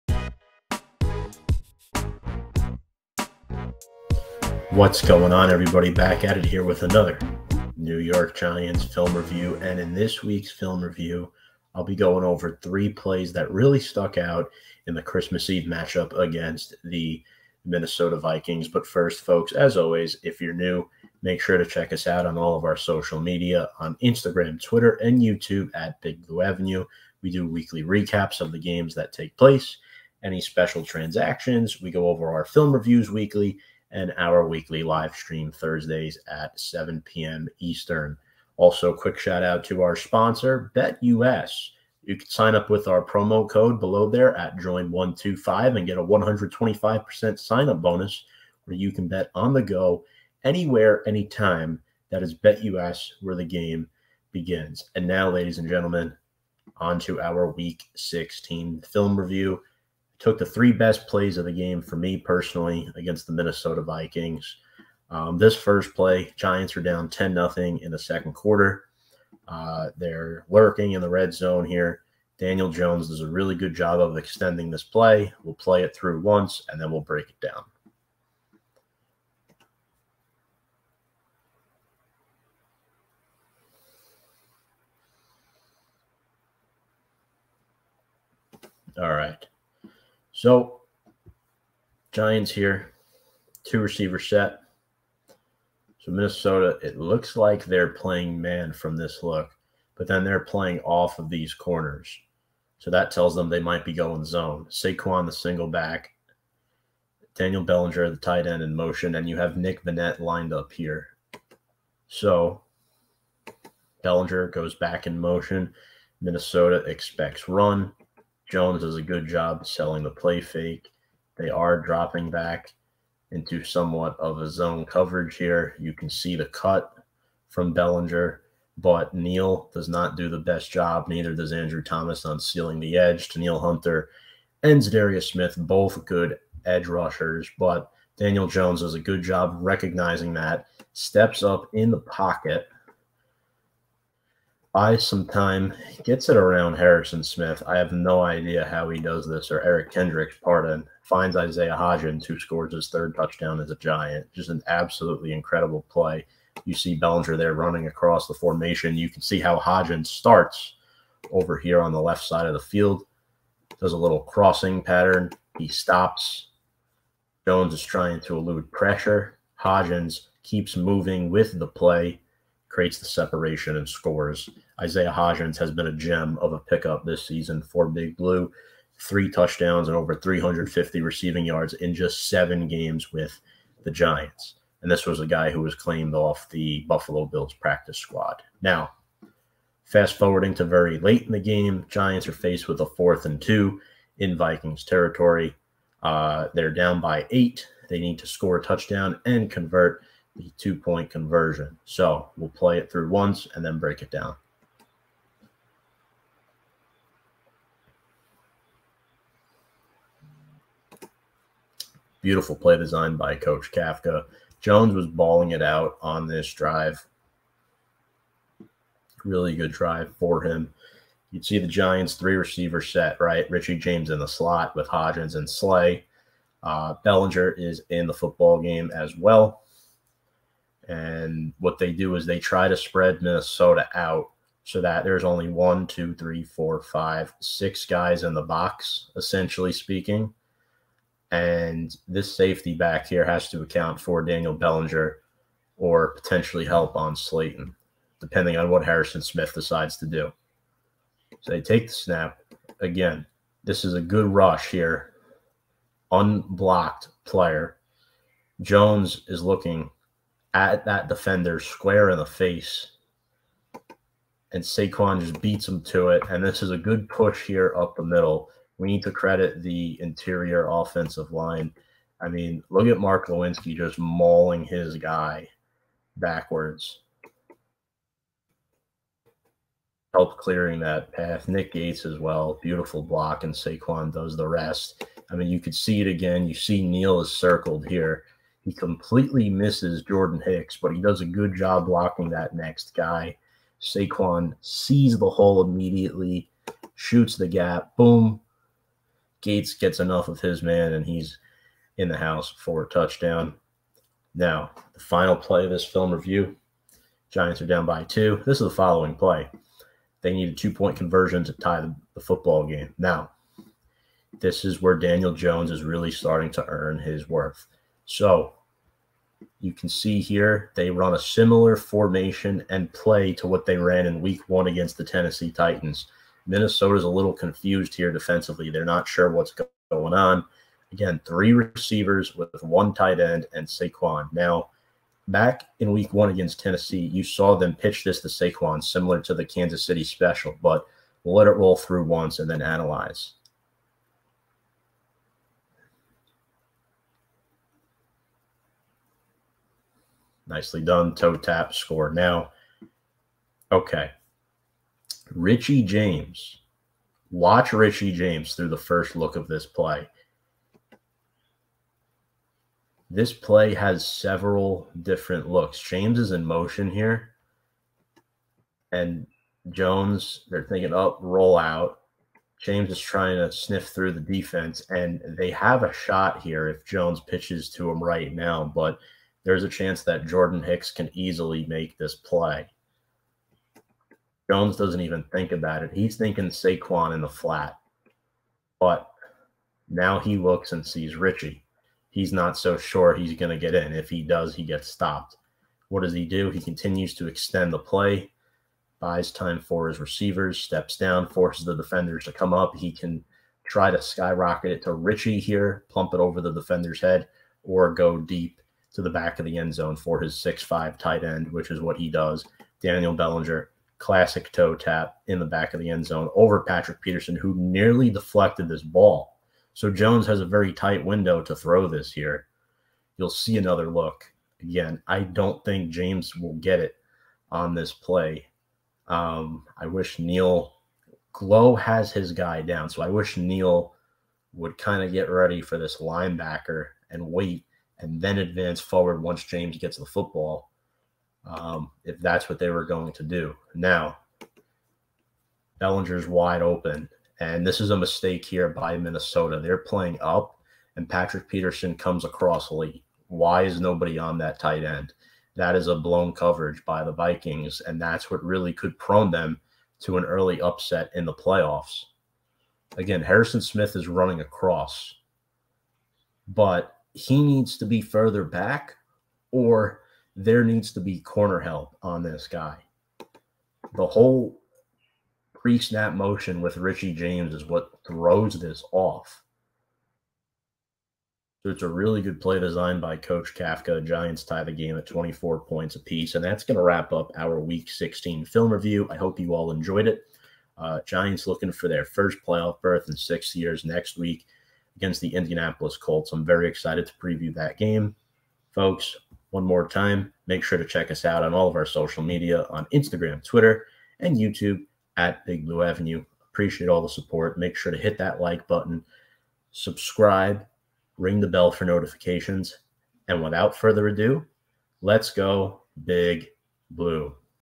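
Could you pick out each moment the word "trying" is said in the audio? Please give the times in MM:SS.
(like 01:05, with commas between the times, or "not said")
02:47, 06:12.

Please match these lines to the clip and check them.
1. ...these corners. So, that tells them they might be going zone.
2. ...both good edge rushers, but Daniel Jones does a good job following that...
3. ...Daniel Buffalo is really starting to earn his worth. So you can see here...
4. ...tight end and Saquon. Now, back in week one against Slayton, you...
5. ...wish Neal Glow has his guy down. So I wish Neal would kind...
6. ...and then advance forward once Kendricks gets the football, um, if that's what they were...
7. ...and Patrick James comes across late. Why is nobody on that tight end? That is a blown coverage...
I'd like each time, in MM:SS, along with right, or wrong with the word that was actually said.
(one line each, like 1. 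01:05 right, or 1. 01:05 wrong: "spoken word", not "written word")
1. 01:41 right
2. 02:15 wrong: "recognizing", not "following"
3. 05:14 wrong: "Jones", not "Buffalo"
4. 05:32 wrong: "Tennessee", not "Slayton"
5. 07:09 right
6. 07:18 wrong: "James", not "Kendricks"
7. 07:30 wrong: "Peterson", not "James".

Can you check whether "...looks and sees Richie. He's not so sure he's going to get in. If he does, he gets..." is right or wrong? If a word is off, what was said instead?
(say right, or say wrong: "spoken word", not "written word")
right.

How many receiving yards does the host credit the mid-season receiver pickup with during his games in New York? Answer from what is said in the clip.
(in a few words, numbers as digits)
over 350.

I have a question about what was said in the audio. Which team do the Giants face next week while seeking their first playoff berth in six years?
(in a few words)
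Indianapolis Colts.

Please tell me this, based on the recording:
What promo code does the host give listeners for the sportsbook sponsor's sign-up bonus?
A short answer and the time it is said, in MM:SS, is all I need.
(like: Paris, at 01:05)
join125, at 00:44.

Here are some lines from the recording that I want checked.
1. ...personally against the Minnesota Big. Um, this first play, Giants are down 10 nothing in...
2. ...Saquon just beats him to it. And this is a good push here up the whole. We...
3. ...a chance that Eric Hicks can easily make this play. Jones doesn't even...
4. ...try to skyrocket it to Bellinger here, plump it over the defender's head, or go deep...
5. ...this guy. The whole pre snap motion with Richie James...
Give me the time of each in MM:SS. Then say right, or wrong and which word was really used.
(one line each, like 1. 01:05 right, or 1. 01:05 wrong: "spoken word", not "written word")
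1. 01:02 wrong: "Vikings", not "Big"
2. 04:24 wrong: "middle", not "whole"
3. 06:19 wrong: "Jordan", not "Eric"
4. 06:43 wrong: "Richie", not "Bellinger"
5. 07:52 right.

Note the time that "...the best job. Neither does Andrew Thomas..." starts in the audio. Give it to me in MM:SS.
02:10.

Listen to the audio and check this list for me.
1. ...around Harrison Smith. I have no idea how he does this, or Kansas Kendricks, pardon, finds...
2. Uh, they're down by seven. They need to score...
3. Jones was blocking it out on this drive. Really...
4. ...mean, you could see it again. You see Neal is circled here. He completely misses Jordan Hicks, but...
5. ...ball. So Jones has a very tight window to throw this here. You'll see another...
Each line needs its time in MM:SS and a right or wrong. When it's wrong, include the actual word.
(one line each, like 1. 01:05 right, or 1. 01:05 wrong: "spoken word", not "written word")
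1. 02:26 wrong: "Eric", not "Kansas"
2. 03:16 wrong: "eight", not "seven"
3. 03:34 wrong: "balling", not "blocking"
4. 04:45 right
5. 06:58 right.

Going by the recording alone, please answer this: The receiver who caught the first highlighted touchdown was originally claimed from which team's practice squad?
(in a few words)
Buffalo Bills.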